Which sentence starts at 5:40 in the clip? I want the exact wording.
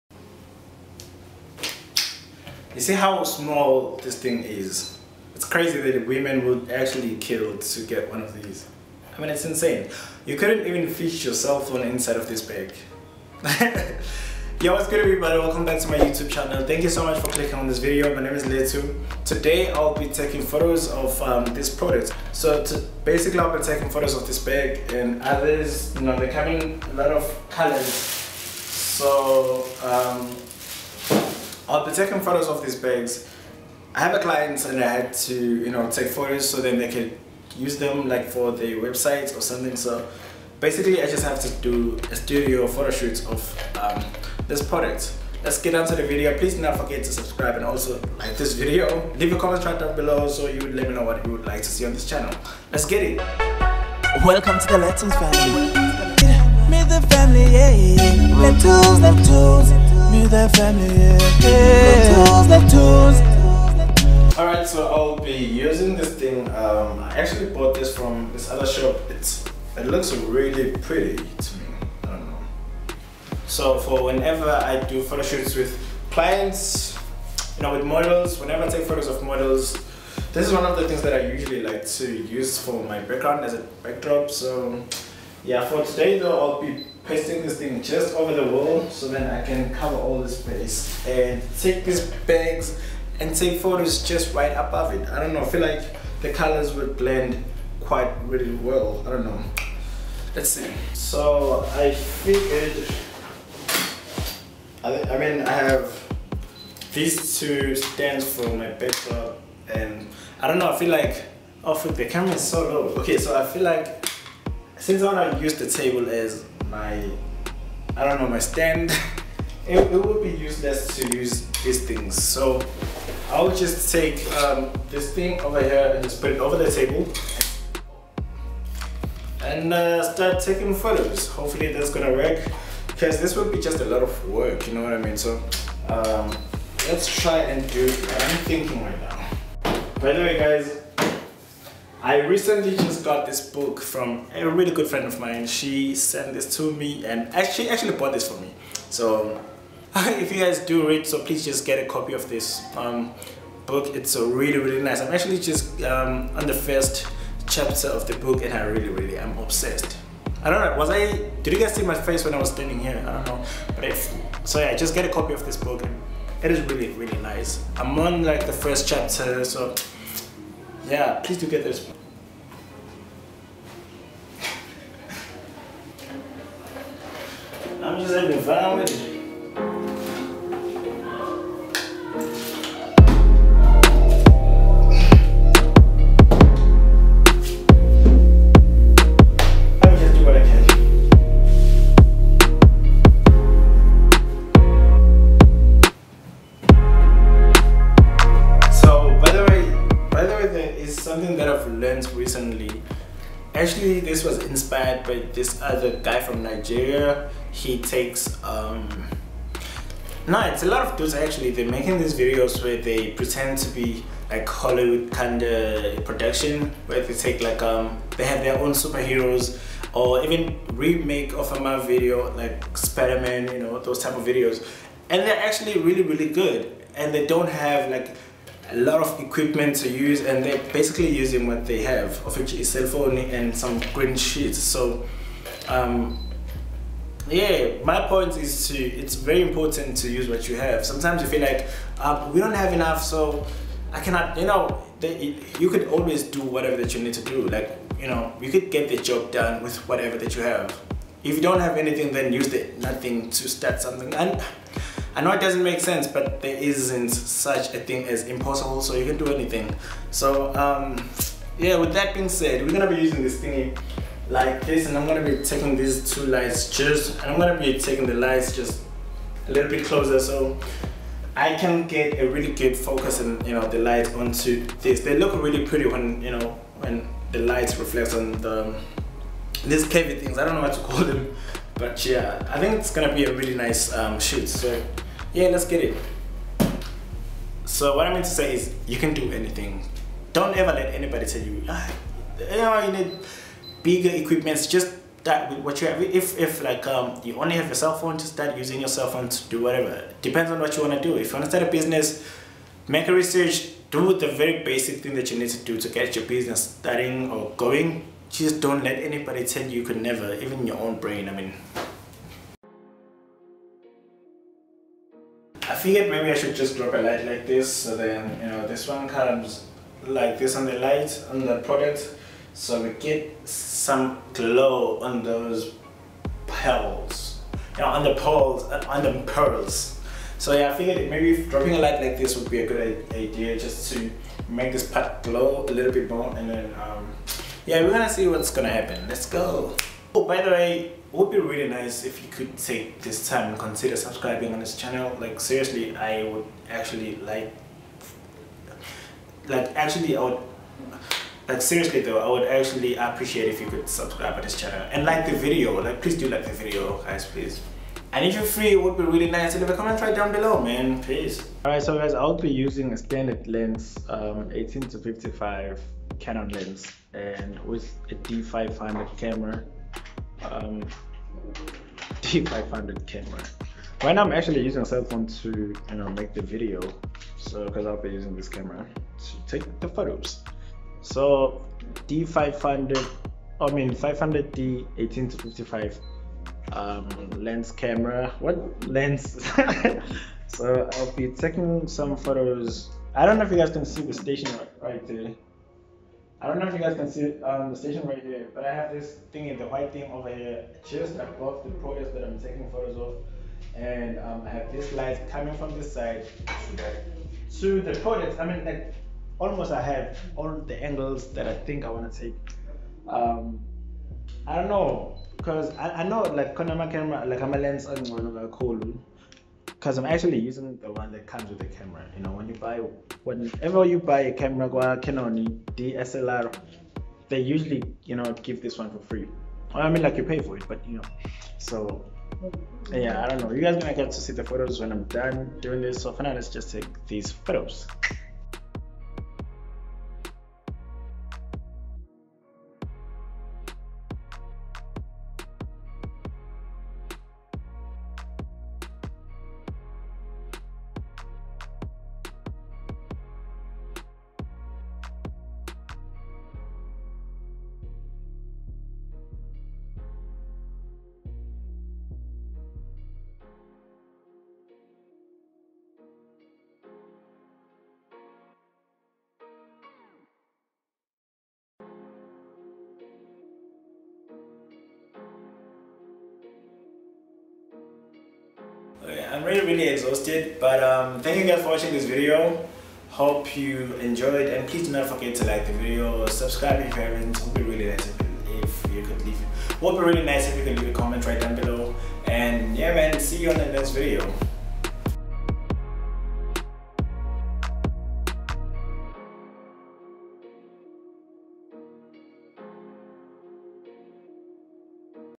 Oh, by the way, it would be really nice if you could take this time and consider subscribing on this channel.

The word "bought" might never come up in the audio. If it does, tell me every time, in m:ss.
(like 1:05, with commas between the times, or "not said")
1:07, 2:27.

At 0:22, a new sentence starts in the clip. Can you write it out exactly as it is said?
So basically, I'll be taking photos of this bag and others, you know, they're coming a lot of colors.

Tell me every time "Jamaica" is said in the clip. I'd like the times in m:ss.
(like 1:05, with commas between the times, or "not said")
not said.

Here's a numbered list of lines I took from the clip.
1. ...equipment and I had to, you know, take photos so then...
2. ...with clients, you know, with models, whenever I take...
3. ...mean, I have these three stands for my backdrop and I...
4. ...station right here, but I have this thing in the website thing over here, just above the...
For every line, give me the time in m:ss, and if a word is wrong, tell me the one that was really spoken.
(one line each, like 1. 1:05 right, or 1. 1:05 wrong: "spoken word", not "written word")
1. 0:34 wrong: "client", not "equipment"
2. 1:15 right
3. 1:45 wrong: "two", not "three"
4. 6:37 wrong: "white", not "website".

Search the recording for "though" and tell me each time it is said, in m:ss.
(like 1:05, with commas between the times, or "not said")
1:26, 5:52.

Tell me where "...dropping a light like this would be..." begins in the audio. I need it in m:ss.
5:31.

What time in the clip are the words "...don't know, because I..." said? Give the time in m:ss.
6:54.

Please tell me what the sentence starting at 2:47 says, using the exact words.
I'm on like the first chapter, so yeah, please do get this.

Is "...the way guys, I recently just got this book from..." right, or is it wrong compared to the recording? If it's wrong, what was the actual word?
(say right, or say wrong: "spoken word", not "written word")
right.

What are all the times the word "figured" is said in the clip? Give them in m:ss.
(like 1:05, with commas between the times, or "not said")
1:41, 5:15, 5:30.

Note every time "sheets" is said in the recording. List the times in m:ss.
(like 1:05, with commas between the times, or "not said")
3:54.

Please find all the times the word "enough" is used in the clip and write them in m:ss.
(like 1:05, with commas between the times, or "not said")
4:02.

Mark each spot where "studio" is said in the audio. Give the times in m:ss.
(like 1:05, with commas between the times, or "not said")
0:42.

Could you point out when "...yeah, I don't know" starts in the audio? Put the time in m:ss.
7:12.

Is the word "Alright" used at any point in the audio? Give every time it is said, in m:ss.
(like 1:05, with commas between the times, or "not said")
1:04, 6:01.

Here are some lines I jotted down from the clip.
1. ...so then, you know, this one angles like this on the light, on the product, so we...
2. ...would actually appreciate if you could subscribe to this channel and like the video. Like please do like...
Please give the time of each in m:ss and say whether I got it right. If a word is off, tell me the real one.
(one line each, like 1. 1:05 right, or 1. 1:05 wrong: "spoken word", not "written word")
1. 5:17 wrong: "comes", not "angles"
2. 5:52 right.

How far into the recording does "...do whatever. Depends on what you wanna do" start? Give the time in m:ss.
4:59.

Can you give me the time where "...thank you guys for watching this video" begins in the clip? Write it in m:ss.
8:01.